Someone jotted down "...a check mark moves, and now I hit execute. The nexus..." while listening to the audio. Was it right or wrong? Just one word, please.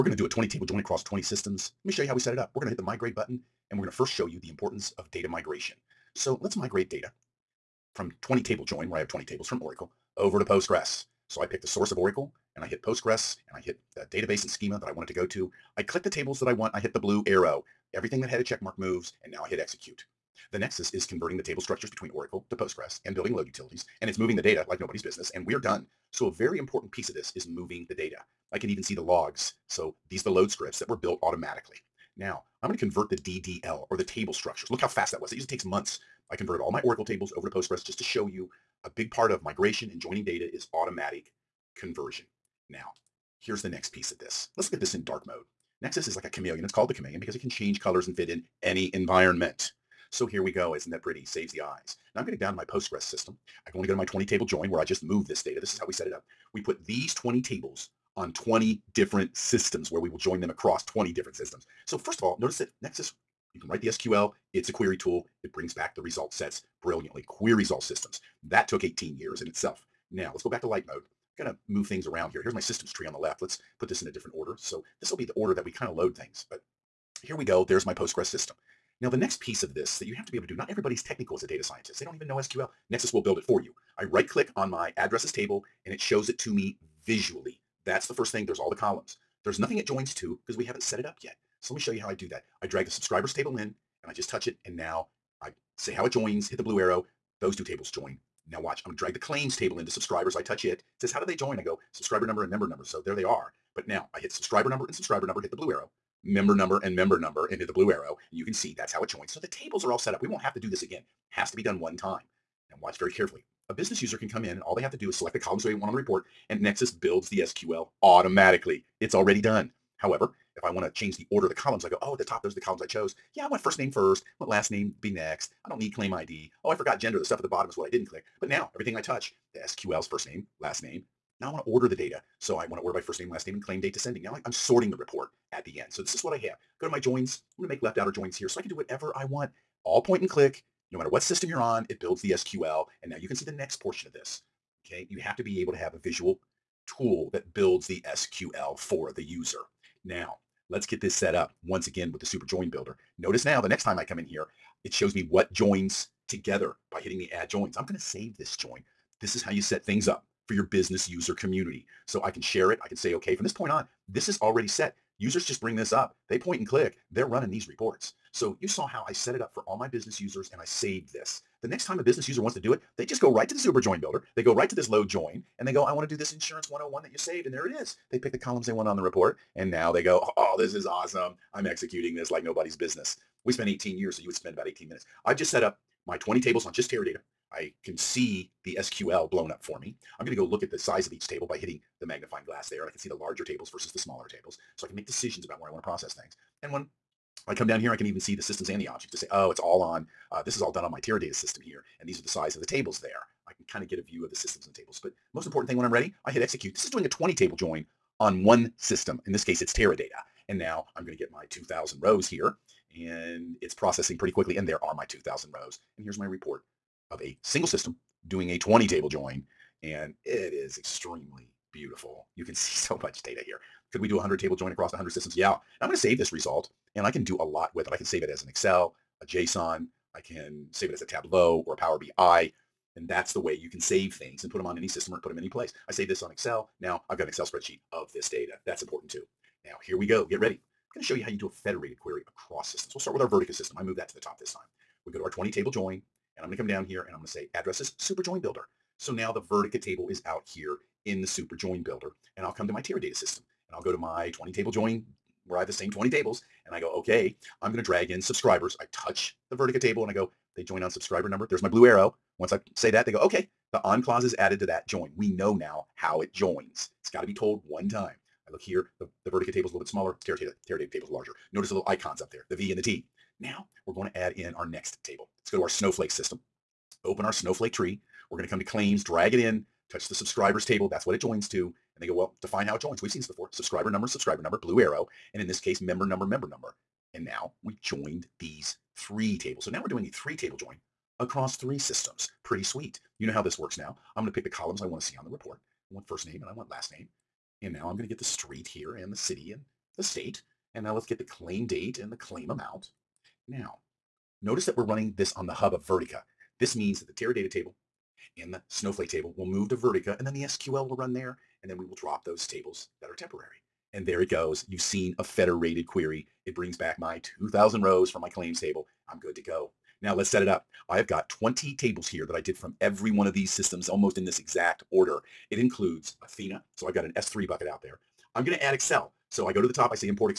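right.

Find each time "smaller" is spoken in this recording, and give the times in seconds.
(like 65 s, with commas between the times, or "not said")
193 s, 269 s.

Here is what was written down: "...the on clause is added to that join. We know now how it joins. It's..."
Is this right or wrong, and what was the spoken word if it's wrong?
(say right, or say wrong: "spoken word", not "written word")
right.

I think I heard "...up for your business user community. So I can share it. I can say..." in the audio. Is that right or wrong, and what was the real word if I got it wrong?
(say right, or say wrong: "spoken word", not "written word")
right.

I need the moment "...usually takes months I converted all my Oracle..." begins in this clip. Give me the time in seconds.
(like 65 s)
35 s.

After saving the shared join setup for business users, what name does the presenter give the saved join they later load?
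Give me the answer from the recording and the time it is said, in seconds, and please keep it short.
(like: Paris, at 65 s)
Insurance 101, at 176 s.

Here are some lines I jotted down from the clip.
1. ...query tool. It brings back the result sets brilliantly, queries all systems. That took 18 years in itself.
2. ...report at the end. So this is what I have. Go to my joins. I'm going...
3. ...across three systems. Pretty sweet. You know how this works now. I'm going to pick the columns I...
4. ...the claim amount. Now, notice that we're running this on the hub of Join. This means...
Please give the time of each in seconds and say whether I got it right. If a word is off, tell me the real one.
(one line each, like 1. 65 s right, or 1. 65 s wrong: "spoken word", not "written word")
1. 64 s right
2. 134 s right
3. 291 s right
4. 302 s wrong: "Vertica", not "Join".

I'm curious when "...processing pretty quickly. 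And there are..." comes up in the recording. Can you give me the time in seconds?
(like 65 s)
213 s.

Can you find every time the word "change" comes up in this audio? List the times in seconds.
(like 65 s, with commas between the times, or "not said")
47 s, 120 s.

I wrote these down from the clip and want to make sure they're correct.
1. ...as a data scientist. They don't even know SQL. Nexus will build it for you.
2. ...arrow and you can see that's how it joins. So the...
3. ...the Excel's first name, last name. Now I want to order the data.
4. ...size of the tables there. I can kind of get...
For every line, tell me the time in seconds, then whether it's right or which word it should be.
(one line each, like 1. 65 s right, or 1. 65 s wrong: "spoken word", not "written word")
1. 81 s right
2. 107 s right
3. 129 s wrong: "SQL", not "Excel"
4. 202 s right.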